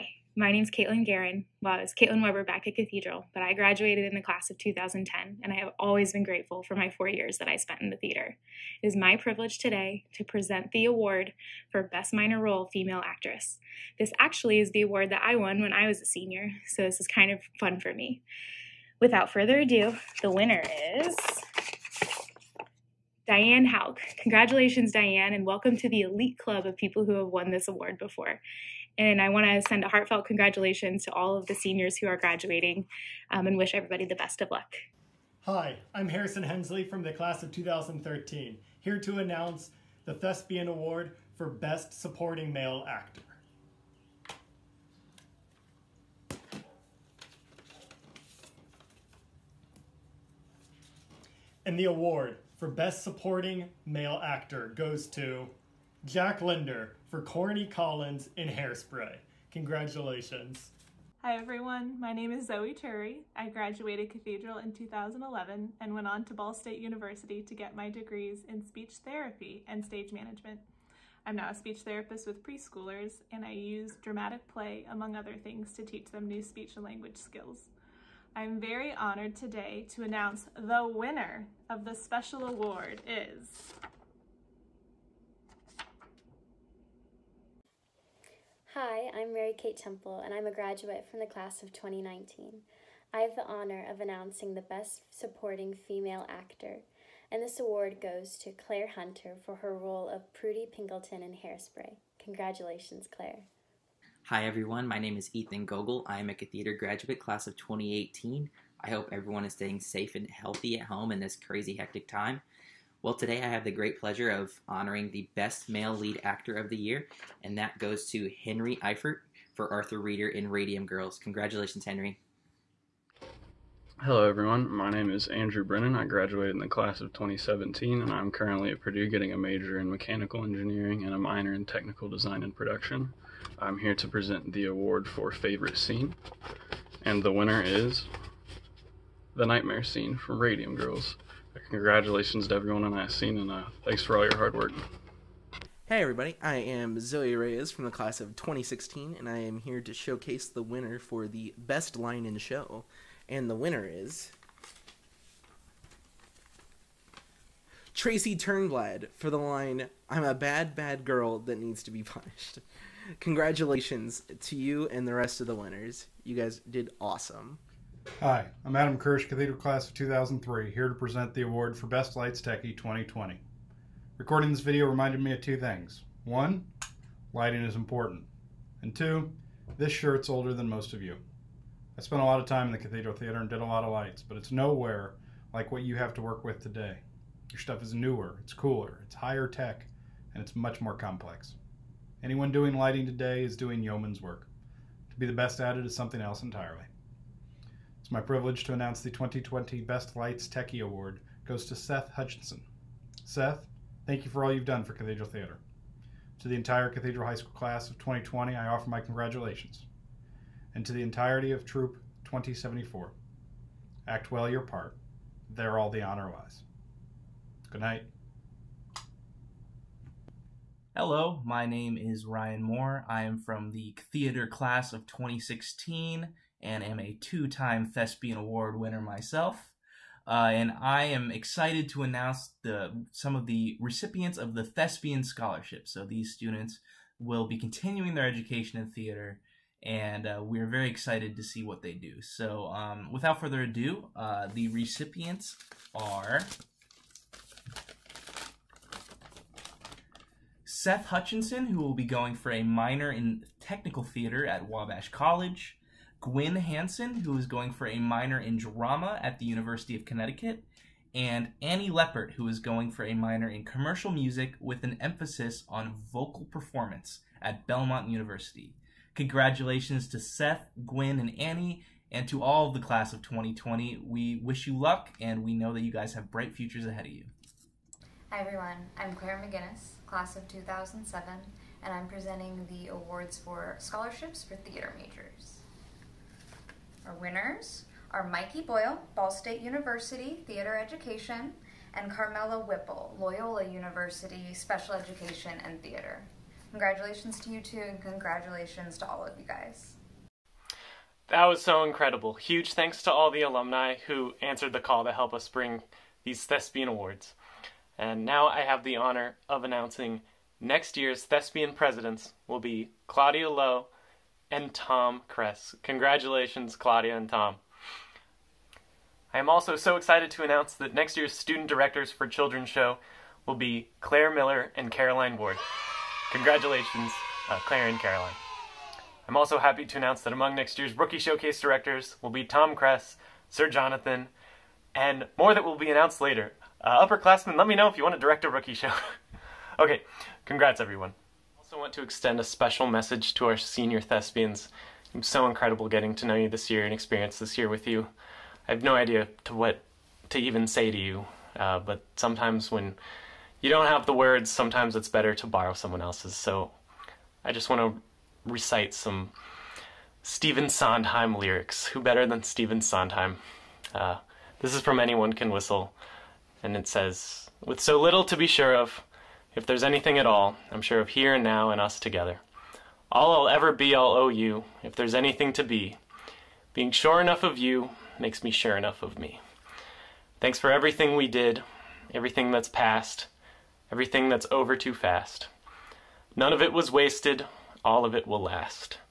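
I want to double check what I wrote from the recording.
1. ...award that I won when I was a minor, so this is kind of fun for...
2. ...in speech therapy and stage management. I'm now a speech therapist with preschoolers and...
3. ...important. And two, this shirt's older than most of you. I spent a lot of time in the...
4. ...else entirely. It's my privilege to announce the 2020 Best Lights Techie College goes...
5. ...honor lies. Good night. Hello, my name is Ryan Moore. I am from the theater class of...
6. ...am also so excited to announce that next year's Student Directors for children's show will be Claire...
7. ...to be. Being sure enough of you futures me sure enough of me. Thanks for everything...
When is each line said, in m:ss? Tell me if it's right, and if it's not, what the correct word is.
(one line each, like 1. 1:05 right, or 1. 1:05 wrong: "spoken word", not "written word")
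1. 0:14 wrong: "senior", not "minor"
2. 1:08 right
3. 2:57 right
4. 3:16 wrong: "Award", not "College"
5. 3:36 right
6. 5:19 right
7. 6:15 wrong: "makes", not "futures".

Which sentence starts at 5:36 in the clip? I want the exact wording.
Uh, upperclassmen, let me know if you want to direct a rookie show.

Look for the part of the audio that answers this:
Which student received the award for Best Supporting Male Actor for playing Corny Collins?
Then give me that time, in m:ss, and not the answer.
0:56.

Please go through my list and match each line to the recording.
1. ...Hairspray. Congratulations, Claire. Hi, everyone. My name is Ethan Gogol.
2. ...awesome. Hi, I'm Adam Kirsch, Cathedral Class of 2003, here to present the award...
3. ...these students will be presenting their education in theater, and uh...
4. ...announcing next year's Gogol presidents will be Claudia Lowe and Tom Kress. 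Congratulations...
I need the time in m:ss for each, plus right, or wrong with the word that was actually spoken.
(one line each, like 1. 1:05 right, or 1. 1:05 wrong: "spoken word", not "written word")
1. 1:41 right
2. 2:47 right
3. 3:56 wrong: "continuing", not "presenting"
4. 5:09 wrong: "Thespian", not "Gogol".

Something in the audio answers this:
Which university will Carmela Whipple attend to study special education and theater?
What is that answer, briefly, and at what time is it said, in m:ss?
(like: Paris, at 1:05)
Loyola University, at 4:53.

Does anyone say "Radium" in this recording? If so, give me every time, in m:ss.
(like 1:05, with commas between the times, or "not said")
2:00, 2:20.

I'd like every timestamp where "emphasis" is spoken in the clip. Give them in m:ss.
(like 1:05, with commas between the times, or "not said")
4:24.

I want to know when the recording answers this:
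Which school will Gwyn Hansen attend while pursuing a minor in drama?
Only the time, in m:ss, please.
4:19.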